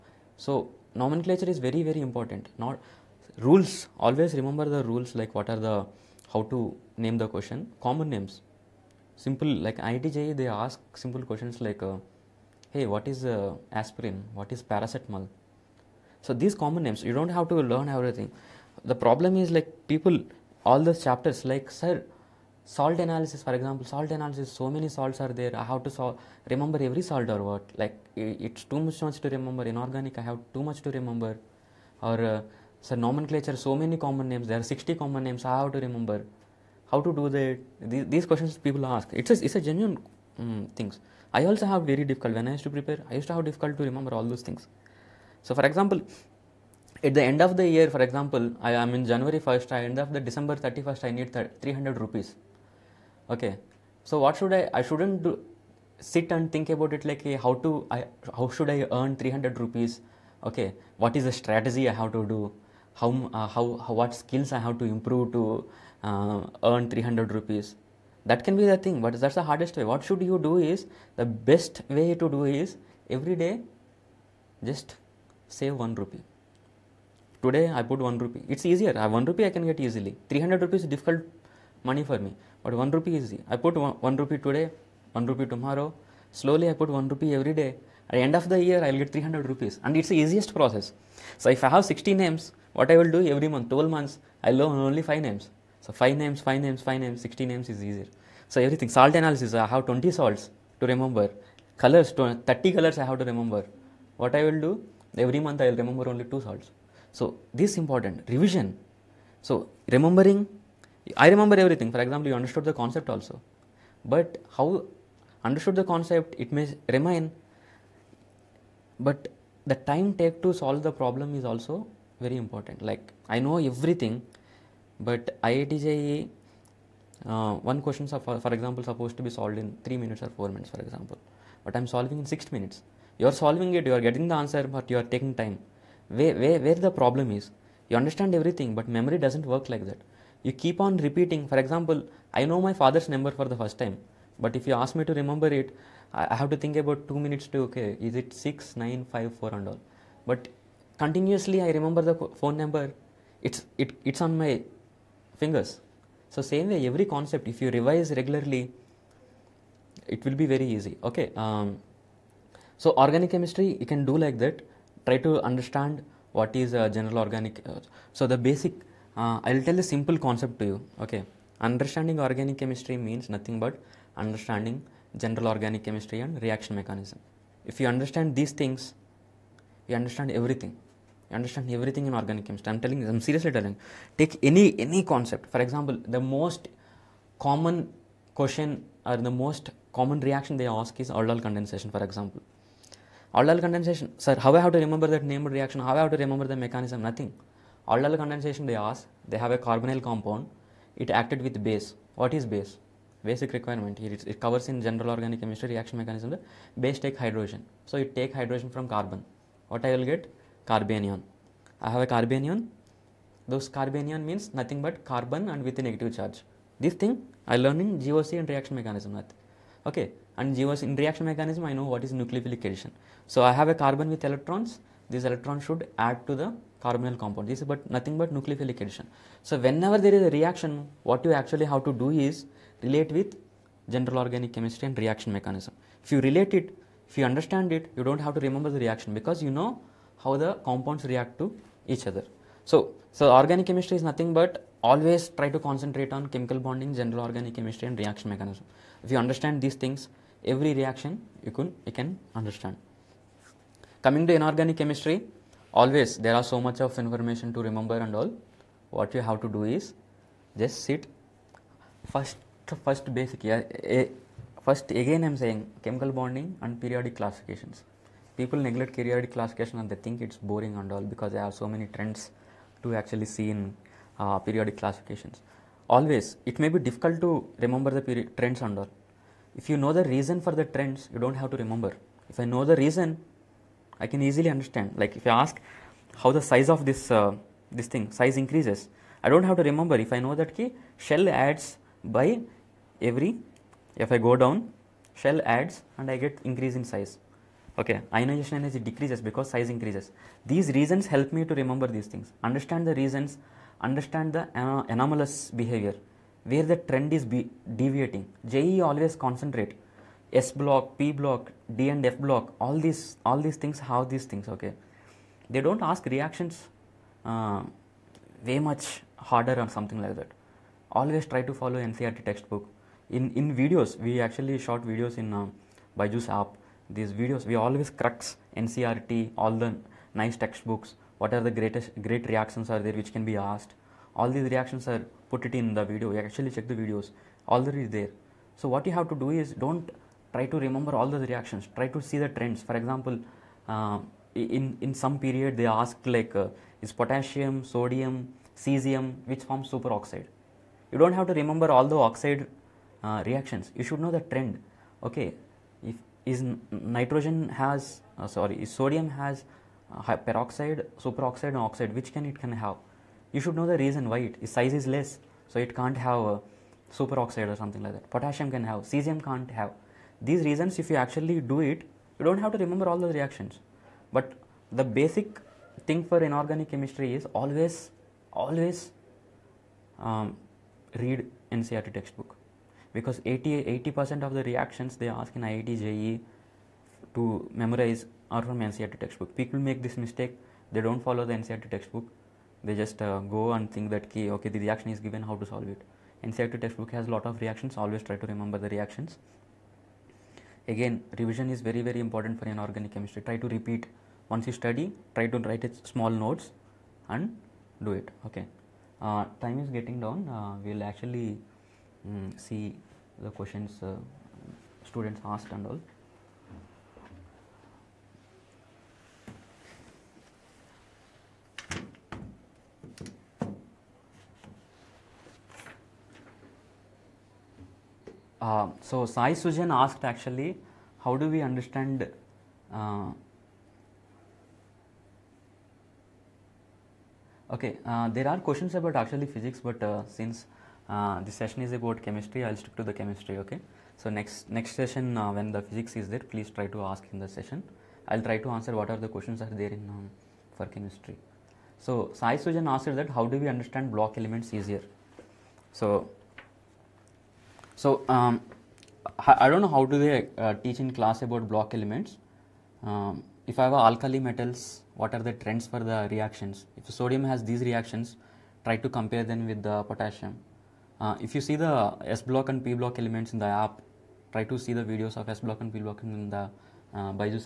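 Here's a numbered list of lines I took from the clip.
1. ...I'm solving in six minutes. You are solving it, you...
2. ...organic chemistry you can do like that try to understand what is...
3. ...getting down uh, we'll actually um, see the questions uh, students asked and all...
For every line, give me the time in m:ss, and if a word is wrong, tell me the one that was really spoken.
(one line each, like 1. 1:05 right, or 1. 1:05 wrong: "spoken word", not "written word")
1. 2:11 right
2. 2:43 right
3. 6:49 right.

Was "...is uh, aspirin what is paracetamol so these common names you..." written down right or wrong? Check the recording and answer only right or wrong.
right.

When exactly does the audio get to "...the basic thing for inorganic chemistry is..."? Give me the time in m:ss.
6:14.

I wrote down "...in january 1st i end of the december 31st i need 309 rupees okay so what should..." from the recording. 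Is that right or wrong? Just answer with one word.
wrong.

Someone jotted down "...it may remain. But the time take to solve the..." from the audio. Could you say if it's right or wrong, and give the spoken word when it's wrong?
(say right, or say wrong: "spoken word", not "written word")
right.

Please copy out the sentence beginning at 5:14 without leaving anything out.
Okay, they don't ask reactions uh, way much harder or something like that.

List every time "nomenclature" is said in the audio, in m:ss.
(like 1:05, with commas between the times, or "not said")
0:00, 0:32.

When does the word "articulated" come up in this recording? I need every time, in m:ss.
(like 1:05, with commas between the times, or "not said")
not said.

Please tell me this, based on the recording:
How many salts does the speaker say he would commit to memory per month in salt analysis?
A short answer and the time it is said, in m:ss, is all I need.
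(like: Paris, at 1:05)
2, at 1:46.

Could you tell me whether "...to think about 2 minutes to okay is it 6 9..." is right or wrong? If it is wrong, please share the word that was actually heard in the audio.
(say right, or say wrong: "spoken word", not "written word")
right.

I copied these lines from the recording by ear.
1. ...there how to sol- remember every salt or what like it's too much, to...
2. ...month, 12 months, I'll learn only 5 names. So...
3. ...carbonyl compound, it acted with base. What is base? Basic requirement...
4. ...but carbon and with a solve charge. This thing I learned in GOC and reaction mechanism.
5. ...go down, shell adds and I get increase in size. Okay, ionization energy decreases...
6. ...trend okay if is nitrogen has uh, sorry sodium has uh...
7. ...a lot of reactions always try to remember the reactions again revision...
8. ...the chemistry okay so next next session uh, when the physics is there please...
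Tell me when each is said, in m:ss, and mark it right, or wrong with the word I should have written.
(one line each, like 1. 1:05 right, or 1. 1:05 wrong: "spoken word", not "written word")
1. 0:25 right
2. 1:33 right
3. 3:19 right
4. 3:34 wrong: "negative", not "solve"
5. 4:54 right
6. 5:54 right
7. 6:37 right
8. 7:22 right.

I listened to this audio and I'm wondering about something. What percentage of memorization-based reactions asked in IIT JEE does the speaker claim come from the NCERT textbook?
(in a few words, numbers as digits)
80 percent.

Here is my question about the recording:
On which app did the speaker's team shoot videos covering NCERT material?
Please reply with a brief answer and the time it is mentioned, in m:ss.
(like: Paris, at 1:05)
Byju's, at 5:25.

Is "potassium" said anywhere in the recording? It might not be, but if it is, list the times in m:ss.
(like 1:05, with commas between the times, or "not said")
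5:46, 6:08, 7:49.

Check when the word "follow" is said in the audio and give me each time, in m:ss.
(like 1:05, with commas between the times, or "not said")
5:21, 6:31.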